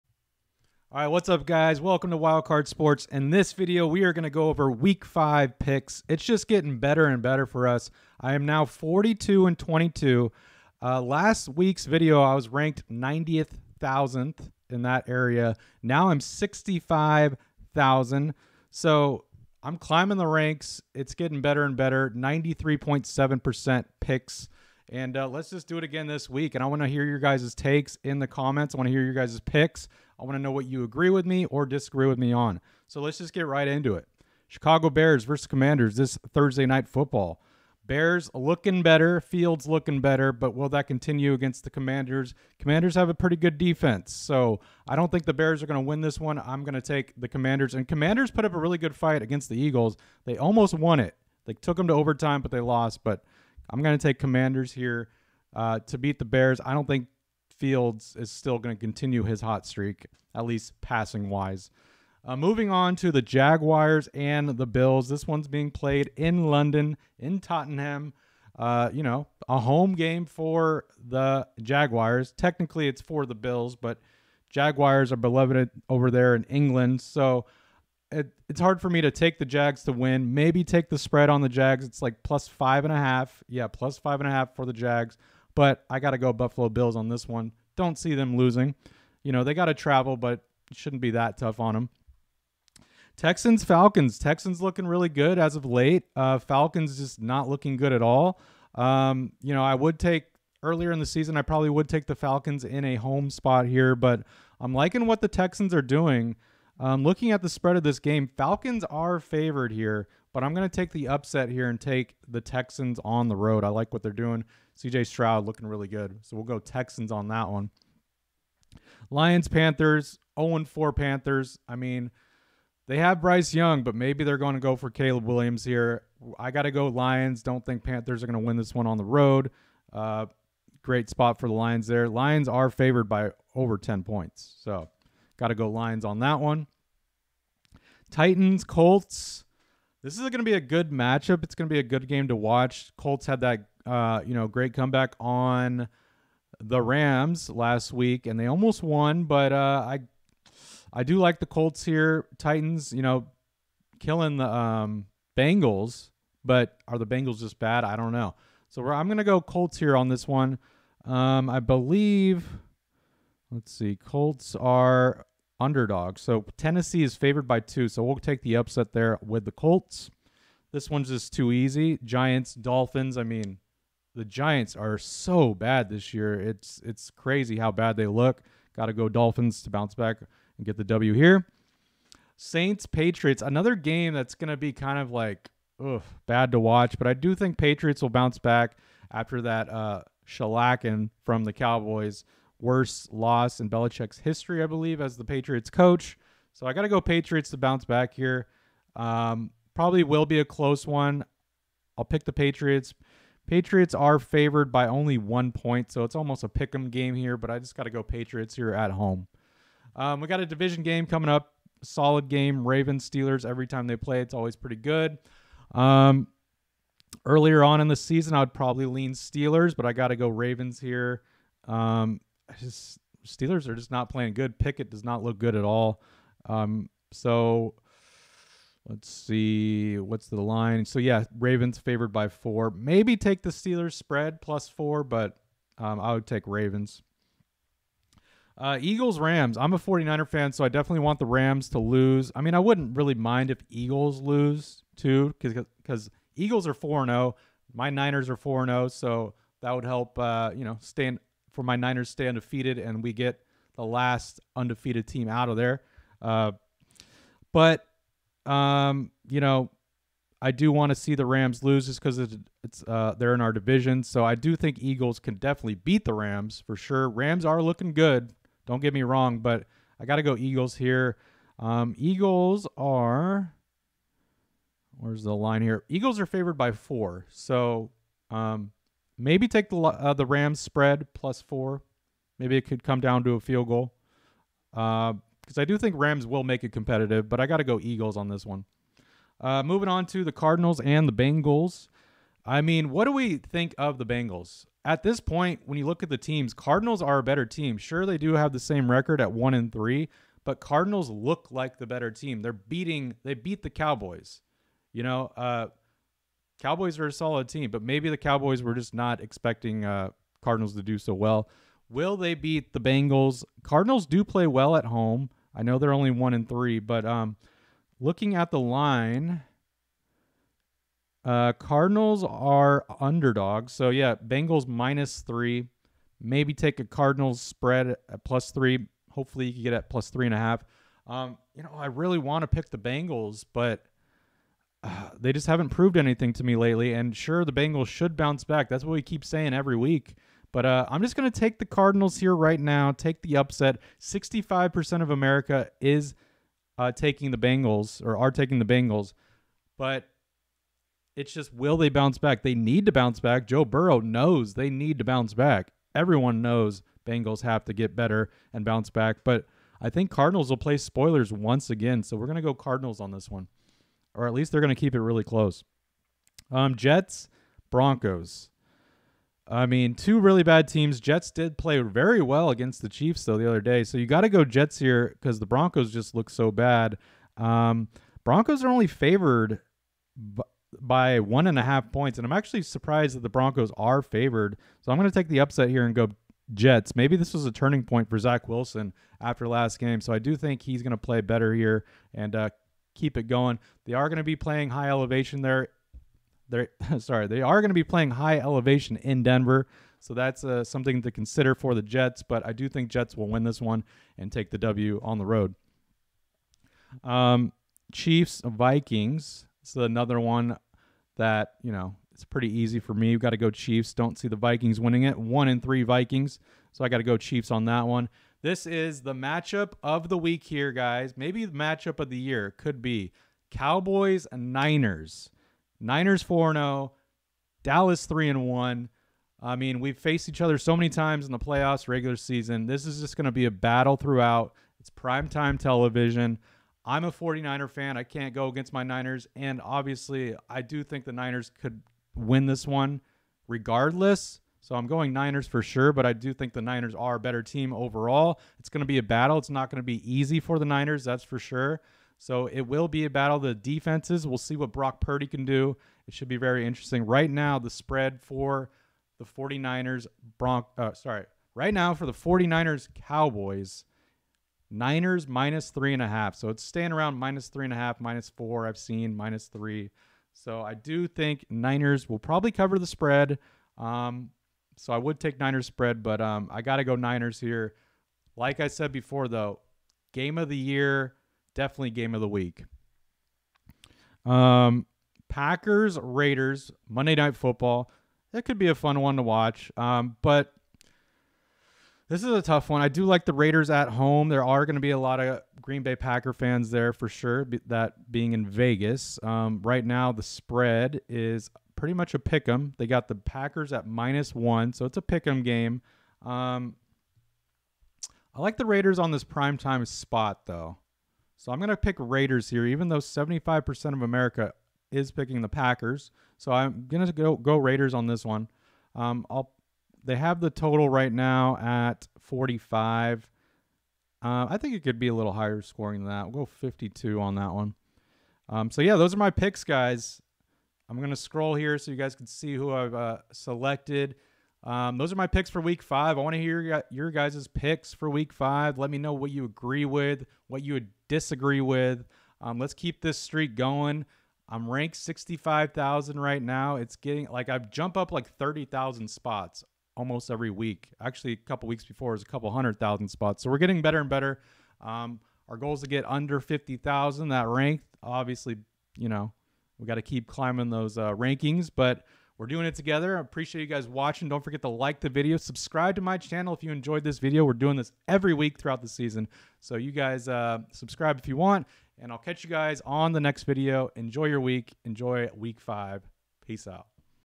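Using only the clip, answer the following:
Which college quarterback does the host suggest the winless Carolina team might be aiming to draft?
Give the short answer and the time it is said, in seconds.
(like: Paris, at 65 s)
Caleb Williams, at 124 s.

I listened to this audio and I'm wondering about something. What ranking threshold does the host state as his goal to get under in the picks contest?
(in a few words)
50,000.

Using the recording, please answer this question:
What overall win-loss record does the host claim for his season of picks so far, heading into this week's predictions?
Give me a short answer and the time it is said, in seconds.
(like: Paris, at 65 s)
42 and 22, at 8 s.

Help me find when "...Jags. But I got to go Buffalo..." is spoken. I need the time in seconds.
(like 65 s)
84 s.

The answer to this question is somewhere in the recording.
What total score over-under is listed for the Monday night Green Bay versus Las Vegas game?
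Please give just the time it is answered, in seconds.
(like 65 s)
522 s.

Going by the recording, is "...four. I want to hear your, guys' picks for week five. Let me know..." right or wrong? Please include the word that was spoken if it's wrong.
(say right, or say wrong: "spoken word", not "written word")
wrong: "five", not "four".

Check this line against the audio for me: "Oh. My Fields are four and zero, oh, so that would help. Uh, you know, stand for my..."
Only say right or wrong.
wrong.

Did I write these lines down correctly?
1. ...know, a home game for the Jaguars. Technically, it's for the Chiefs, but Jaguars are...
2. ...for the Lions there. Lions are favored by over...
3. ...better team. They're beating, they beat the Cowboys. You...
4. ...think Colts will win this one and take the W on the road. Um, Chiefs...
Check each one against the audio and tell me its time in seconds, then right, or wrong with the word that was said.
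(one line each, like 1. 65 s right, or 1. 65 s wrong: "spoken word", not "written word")
1. 69 s wrong: "Bills", not "Chiefs"
2. 131 s right
3. 301 s right
4. 402 s wrong: "Jets", not "Colts".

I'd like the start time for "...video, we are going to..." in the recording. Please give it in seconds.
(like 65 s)
3 s.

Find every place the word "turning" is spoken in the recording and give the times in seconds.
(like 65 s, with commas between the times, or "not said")
387 s.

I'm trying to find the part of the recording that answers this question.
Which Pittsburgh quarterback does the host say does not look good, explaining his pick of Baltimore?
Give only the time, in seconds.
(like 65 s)
224 s.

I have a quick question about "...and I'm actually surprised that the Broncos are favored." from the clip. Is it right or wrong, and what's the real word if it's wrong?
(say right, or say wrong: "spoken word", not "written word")
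right.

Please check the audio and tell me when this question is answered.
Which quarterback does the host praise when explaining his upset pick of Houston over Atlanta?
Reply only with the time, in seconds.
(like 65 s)
114 s.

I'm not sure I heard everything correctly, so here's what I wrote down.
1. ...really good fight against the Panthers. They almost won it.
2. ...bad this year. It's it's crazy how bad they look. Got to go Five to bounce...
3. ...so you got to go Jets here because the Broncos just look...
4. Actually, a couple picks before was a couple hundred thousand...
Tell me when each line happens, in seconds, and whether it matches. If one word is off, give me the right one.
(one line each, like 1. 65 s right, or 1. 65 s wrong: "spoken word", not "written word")
1. 48 s wrong: "Eagles", not "Panthers"
2. 175 s wrong: "Dolphins", not "Five"
3. 373 s right
4. 551 s wrong: "weeks", not "picks".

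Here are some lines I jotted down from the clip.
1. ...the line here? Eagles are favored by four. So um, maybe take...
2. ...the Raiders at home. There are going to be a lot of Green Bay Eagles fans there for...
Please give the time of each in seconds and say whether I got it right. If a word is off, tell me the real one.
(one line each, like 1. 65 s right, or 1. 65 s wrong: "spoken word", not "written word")
1. 275 s right
2. 493 s wrong: "Packer", not "Eagles".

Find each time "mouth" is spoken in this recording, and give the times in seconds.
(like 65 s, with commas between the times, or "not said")
not said.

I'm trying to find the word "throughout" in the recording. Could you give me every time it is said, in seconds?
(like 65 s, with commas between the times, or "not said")
433 s, 568 s.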